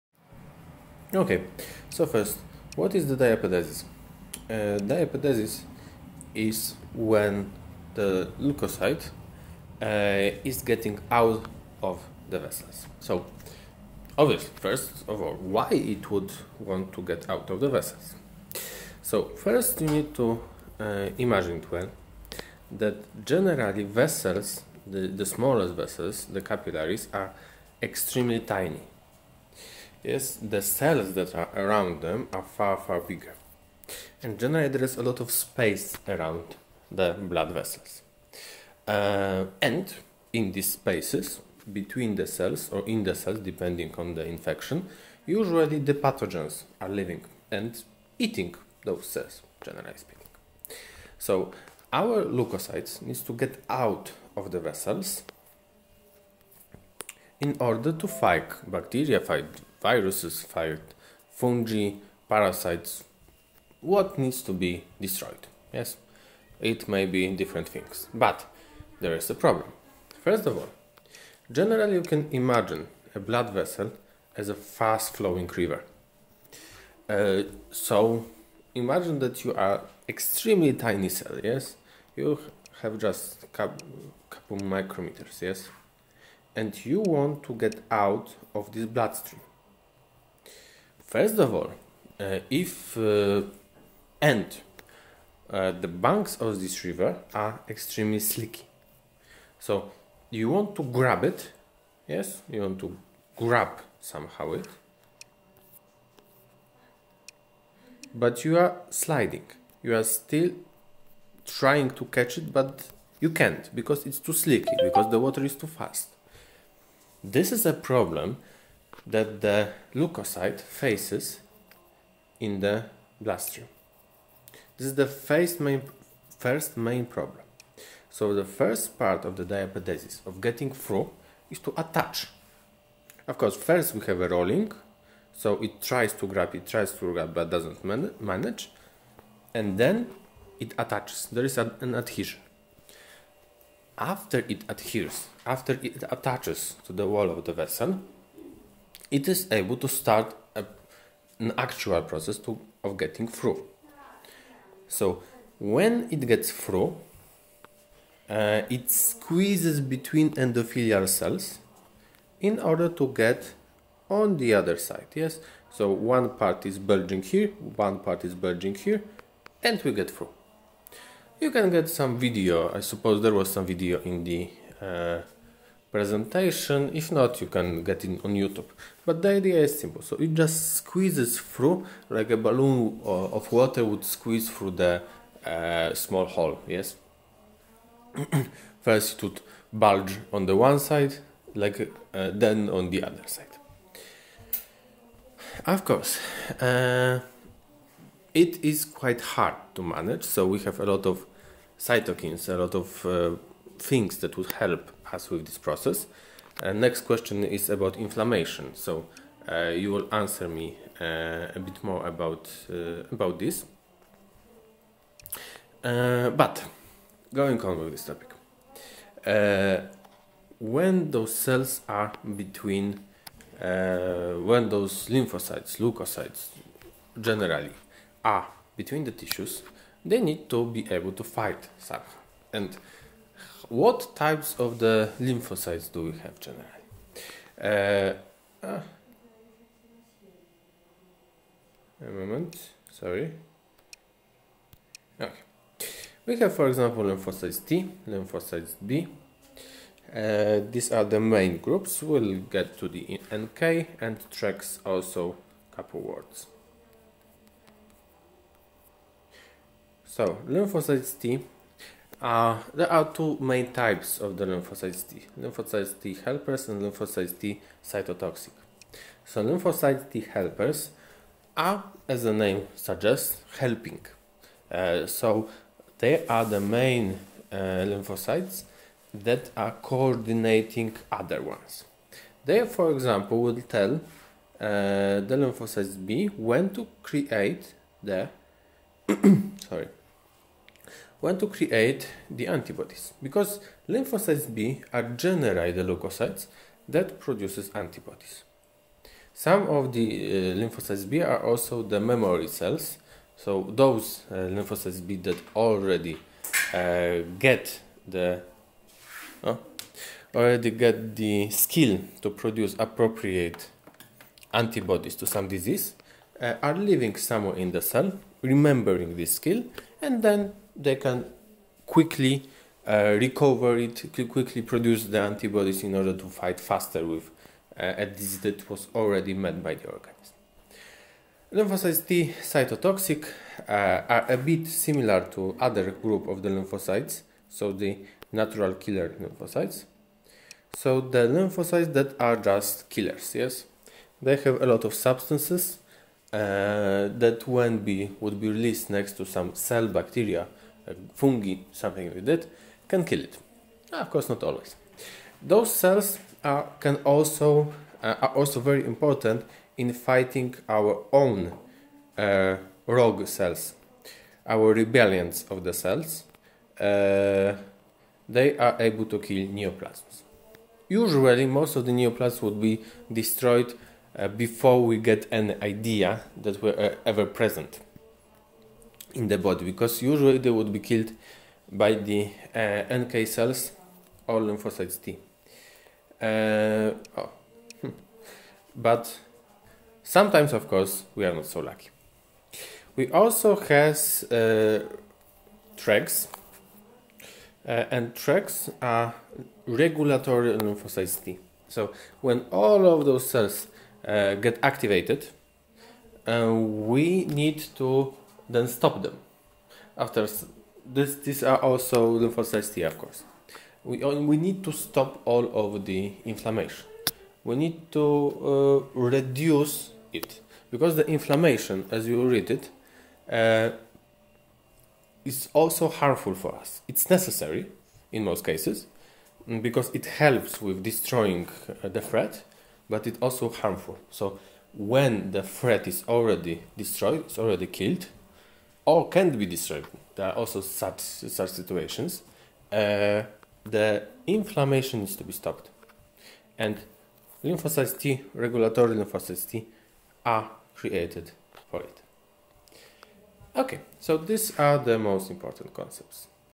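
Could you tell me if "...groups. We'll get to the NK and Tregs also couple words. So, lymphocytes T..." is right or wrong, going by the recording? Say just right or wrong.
right.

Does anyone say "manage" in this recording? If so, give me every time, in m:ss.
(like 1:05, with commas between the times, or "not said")
2:18, 3:19.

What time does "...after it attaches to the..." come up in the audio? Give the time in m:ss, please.
2:25.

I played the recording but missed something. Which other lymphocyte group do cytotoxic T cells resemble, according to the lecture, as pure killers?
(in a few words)
natural killer lymphocytes.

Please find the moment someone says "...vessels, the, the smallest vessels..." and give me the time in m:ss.
0:23.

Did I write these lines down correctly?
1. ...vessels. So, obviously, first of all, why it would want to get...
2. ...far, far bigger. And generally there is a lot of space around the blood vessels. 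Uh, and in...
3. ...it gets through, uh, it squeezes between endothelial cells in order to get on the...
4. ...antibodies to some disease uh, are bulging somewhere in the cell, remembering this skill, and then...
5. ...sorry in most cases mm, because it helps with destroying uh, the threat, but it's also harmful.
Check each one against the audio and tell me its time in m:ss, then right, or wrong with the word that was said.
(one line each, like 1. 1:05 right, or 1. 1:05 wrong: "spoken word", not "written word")
1. 0:12 right
2. 0:32 right
3. 2:36 right
4. 5:14 wrong: "living", not "bulging"
5. 7:07 wrong: "necessary", not "sorry".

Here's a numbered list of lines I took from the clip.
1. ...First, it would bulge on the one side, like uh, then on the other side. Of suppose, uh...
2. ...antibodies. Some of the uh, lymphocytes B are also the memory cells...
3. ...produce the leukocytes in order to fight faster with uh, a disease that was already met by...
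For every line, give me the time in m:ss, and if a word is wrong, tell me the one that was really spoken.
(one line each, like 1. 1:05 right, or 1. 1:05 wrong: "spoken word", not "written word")
1. 3:08 wrong: "course", not "suppose"
2. 4:57 right
3. 5:24 wrong: "antibodies", not "leukocytes".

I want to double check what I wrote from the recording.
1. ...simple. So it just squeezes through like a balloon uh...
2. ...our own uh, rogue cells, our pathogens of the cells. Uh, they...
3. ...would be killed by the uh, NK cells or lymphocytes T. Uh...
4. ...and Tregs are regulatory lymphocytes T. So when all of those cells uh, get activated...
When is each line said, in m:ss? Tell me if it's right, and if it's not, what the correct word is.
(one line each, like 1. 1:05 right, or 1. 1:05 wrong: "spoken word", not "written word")
1. 2:59 right
2. 6:00 wrong: "rebellions", not "pathogens"
3. 6:20 right
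4. 6:37 right.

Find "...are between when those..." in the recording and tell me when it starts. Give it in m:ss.
3:41.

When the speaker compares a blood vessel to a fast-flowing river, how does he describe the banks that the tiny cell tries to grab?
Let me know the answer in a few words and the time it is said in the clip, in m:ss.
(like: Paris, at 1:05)
extremely slicky, at 1:37.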